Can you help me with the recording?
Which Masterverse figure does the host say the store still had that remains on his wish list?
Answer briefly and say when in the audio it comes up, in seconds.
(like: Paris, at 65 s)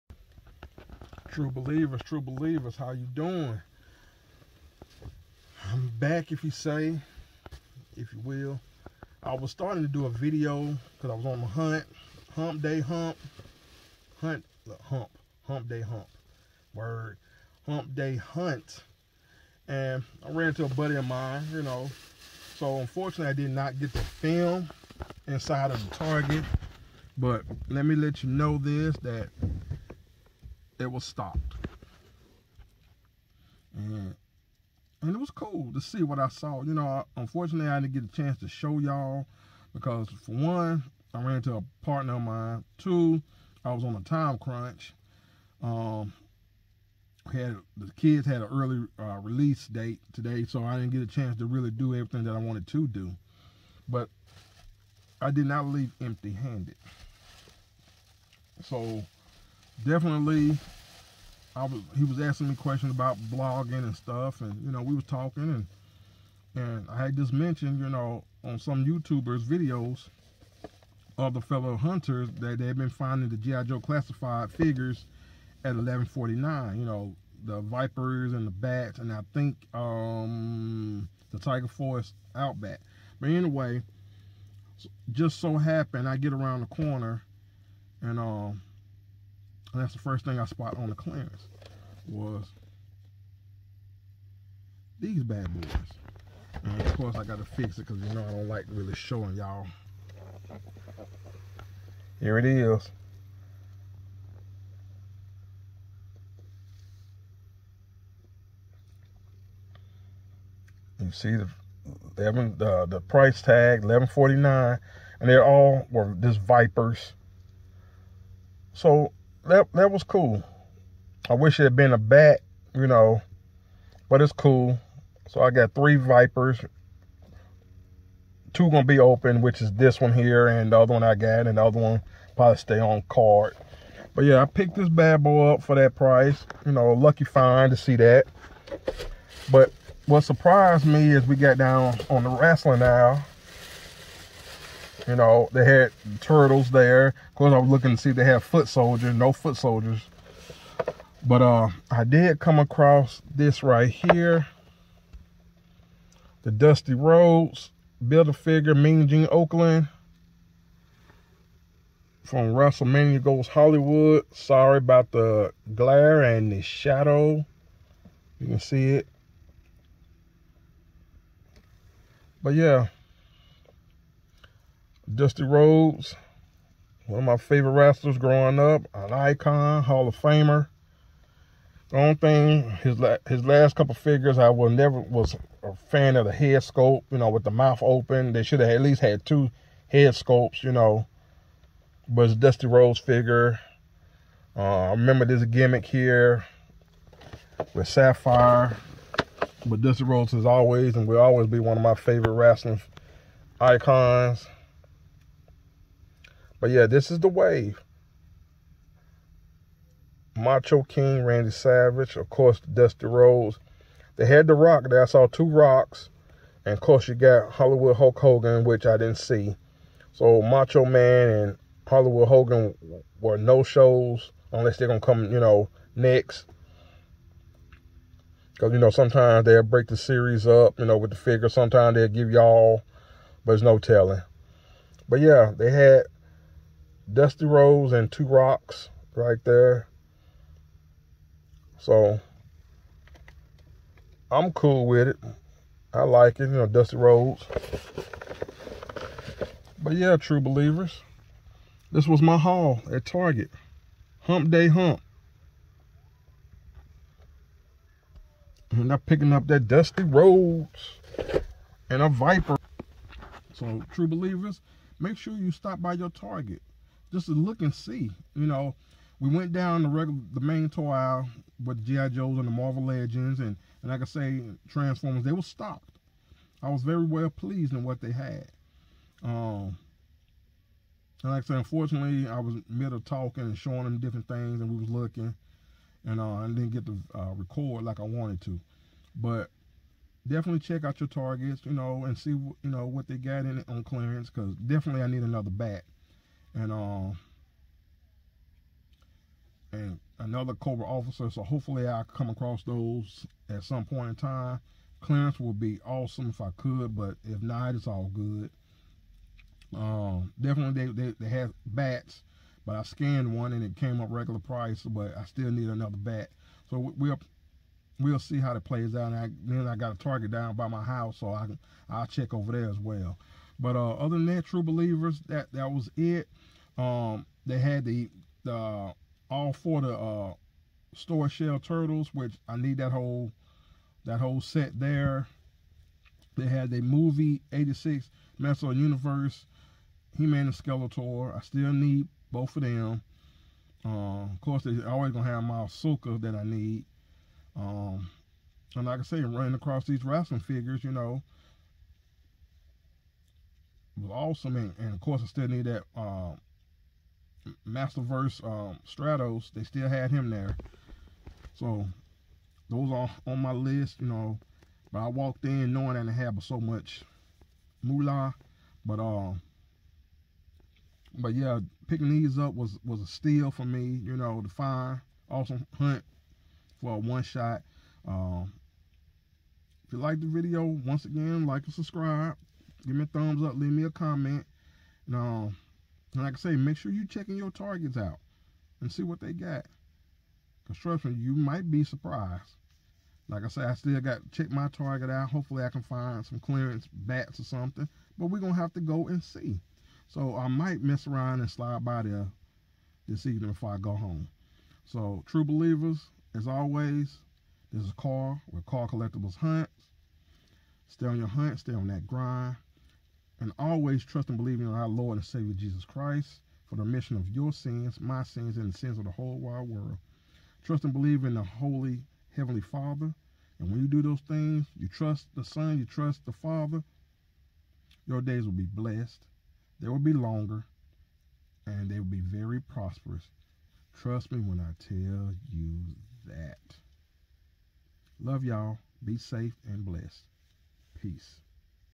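Stratos, at 358 s.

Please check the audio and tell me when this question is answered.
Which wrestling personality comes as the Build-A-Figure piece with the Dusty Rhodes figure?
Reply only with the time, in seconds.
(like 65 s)
158 s.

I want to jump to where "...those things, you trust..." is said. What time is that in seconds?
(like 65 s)
424 s.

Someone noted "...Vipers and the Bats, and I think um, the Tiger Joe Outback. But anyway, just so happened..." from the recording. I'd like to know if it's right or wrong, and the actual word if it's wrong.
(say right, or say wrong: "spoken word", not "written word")
wrong: "Force", not "Joe".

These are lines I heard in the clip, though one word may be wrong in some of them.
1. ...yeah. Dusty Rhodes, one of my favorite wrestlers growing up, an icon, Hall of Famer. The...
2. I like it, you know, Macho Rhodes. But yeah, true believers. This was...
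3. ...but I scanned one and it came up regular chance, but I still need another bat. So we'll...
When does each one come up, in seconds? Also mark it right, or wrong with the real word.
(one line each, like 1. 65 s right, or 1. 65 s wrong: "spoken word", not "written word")
1. 172 s right
2. 245 s wrong: "Dusty", not "Macho"
3. 312 s wrong: "price", not "chance".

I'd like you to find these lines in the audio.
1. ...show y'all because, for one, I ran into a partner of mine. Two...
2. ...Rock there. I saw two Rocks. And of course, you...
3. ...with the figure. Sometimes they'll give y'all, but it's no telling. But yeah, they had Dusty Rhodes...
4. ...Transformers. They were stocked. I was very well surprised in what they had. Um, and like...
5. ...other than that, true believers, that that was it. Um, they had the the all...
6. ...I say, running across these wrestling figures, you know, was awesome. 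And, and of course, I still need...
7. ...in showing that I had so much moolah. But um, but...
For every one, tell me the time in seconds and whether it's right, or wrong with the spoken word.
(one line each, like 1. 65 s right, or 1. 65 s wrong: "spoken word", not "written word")
1. 38 s right
2. 214 s right
3. 230 s right
4. 274 s wrong: "pleased", not "surprised"
5. 323 s right
6. 349 s right
7. 365 s wrong: "knowing", not "showing".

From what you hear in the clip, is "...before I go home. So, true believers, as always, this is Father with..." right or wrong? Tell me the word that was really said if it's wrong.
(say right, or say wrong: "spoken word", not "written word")
wrong: "Carl", not "Father".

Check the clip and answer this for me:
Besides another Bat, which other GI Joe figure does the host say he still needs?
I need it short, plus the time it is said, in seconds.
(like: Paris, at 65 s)
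Cobra officer, at 300 s.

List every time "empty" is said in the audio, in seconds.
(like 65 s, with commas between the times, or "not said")
56 s.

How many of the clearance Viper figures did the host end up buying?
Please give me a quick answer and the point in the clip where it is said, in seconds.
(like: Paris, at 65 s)
3, at 125 s.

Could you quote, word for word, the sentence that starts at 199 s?
But Dusty Rhodes is always and will always be one of my favorite wrestling icons.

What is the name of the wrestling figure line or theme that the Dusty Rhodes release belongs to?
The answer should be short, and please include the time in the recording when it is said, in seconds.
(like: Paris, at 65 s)
WrestleMania Goes Hollywood, at 162 s.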